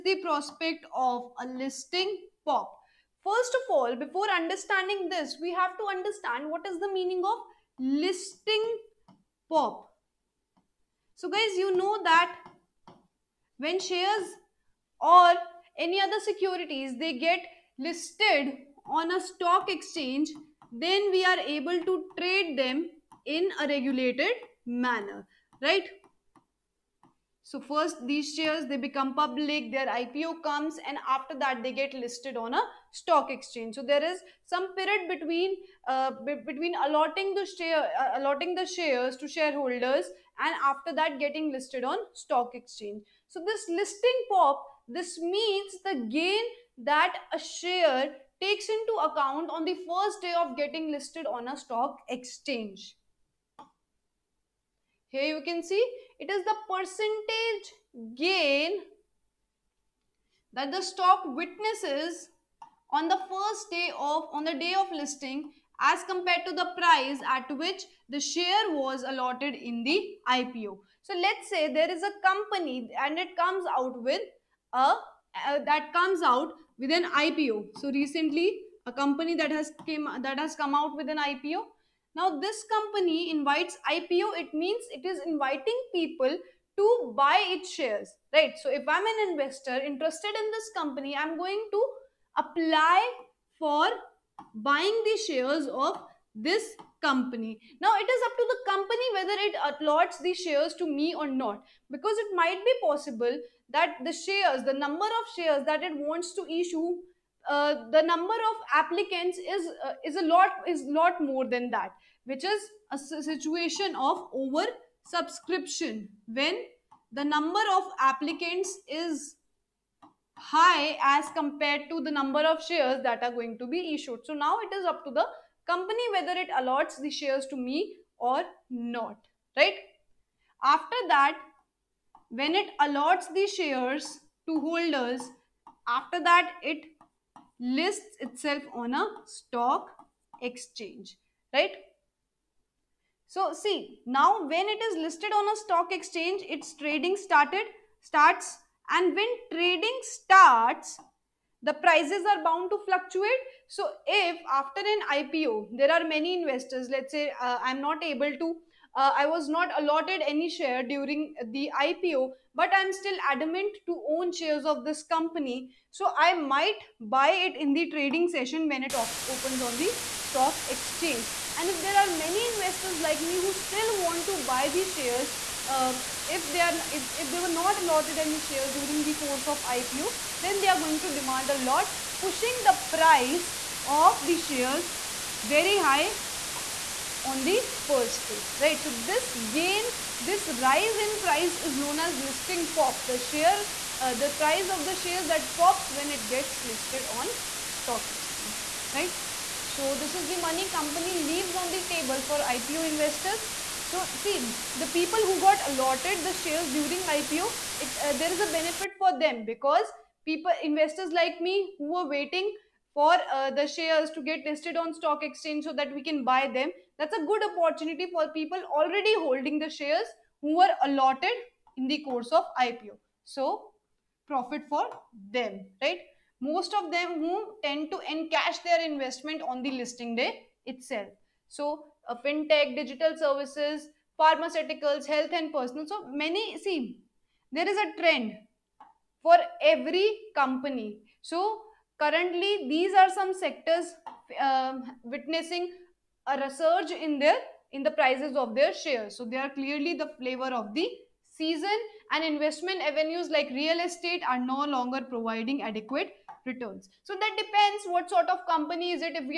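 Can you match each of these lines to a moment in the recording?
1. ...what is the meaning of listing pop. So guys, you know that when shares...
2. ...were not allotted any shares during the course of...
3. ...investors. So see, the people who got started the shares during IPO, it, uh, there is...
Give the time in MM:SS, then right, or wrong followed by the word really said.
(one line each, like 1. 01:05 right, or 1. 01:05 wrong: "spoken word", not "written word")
1. 00:06 right
2. 02:57 right
3. 03:22 wrong: "allotted", not "started".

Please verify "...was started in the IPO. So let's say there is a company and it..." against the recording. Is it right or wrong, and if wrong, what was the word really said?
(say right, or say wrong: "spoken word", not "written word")
wrong: "allotted", not "started".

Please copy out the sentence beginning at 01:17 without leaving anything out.
So recently, a company that has came that has come out with an IPO.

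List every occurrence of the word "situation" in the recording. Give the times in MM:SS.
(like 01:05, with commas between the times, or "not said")
01:53.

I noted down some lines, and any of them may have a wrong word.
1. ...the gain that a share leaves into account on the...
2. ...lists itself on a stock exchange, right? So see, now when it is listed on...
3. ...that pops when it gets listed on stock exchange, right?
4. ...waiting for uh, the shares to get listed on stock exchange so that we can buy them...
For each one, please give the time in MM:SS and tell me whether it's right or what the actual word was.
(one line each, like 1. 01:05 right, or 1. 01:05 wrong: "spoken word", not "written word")
1. 00:45 wrong: "takes", not "leaves"
2. 02:17 right
3. 03:15 right
4. 03:32 right.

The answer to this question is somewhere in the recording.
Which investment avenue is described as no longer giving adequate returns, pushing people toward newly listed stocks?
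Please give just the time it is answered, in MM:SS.
04:13.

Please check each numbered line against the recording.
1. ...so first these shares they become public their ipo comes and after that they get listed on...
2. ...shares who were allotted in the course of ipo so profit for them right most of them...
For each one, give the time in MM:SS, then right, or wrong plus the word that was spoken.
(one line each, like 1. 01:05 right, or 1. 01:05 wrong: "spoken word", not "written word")
1. 00:27 right
2. 03:39 right.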